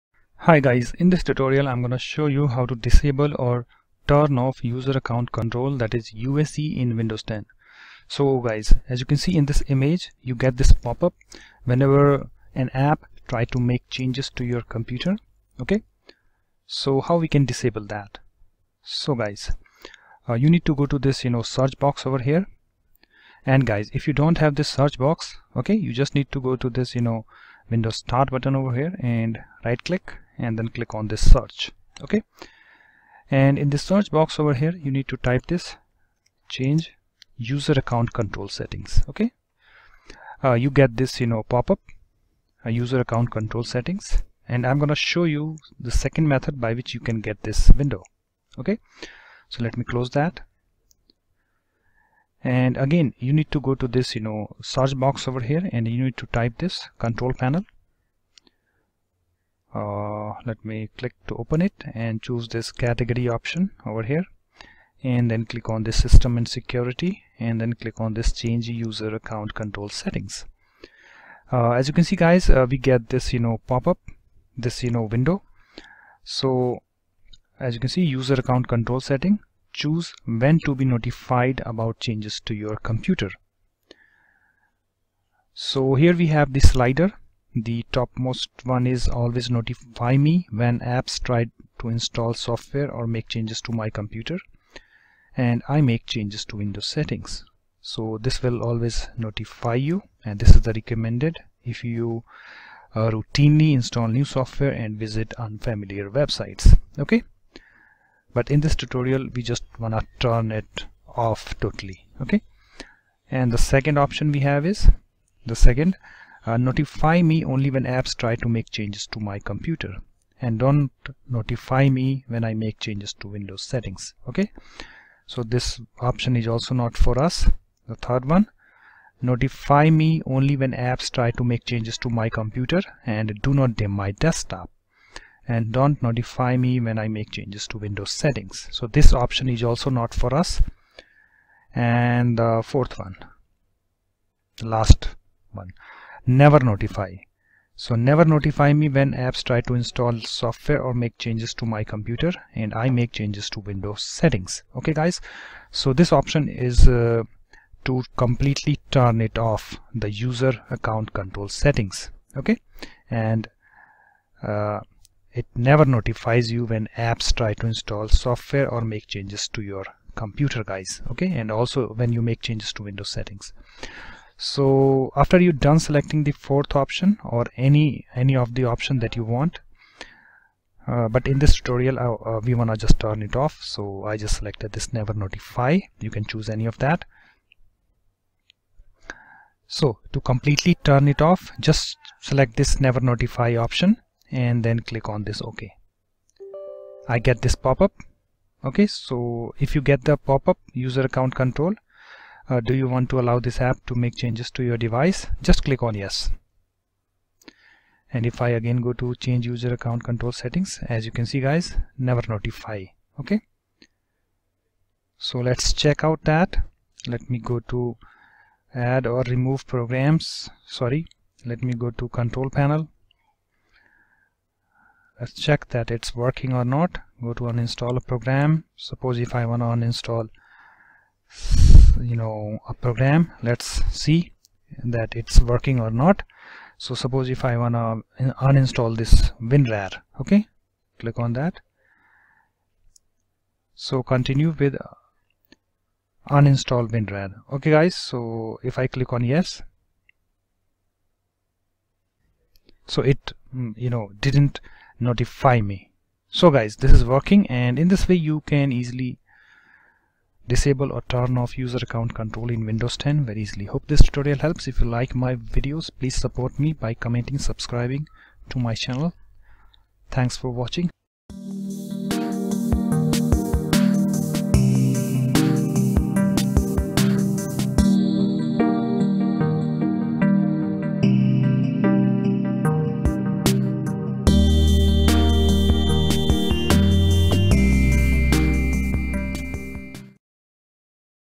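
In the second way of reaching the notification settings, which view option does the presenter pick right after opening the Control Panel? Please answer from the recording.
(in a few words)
Category.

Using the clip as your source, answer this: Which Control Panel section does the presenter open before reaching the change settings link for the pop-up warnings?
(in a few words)
System and Security.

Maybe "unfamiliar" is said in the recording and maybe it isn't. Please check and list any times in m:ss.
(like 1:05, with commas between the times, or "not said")
1:45.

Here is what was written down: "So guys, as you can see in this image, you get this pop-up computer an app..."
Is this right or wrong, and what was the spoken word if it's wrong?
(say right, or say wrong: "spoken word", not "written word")
wrong: "whenever", not "computer".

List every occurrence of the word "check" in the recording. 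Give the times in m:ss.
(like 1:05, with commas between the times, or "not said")
3:35, 3:45.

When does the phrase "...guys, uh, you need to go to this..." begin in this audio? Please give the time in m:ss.
0:19.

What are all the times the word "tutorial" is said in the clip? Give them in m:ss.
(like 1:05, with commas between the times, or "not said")
0:01, 1:48, 3:01, 4:24.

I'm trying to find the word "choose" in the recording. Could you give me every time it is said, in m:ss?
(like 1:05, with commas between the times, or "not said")
1:02, 1:19, 3:06.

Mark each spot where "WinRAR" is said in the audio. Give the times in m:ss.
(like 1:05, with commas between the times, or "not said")
3:59, 4:06.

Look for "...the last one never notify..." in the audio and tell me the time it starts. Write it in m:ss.
2:24.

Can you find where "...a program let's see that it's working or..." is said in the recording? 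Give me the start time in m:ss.
3:52.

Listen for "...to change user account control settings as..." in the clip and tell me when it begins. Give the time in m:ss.
3:29.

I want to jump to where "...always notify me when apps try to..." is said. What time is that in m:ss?
1:29.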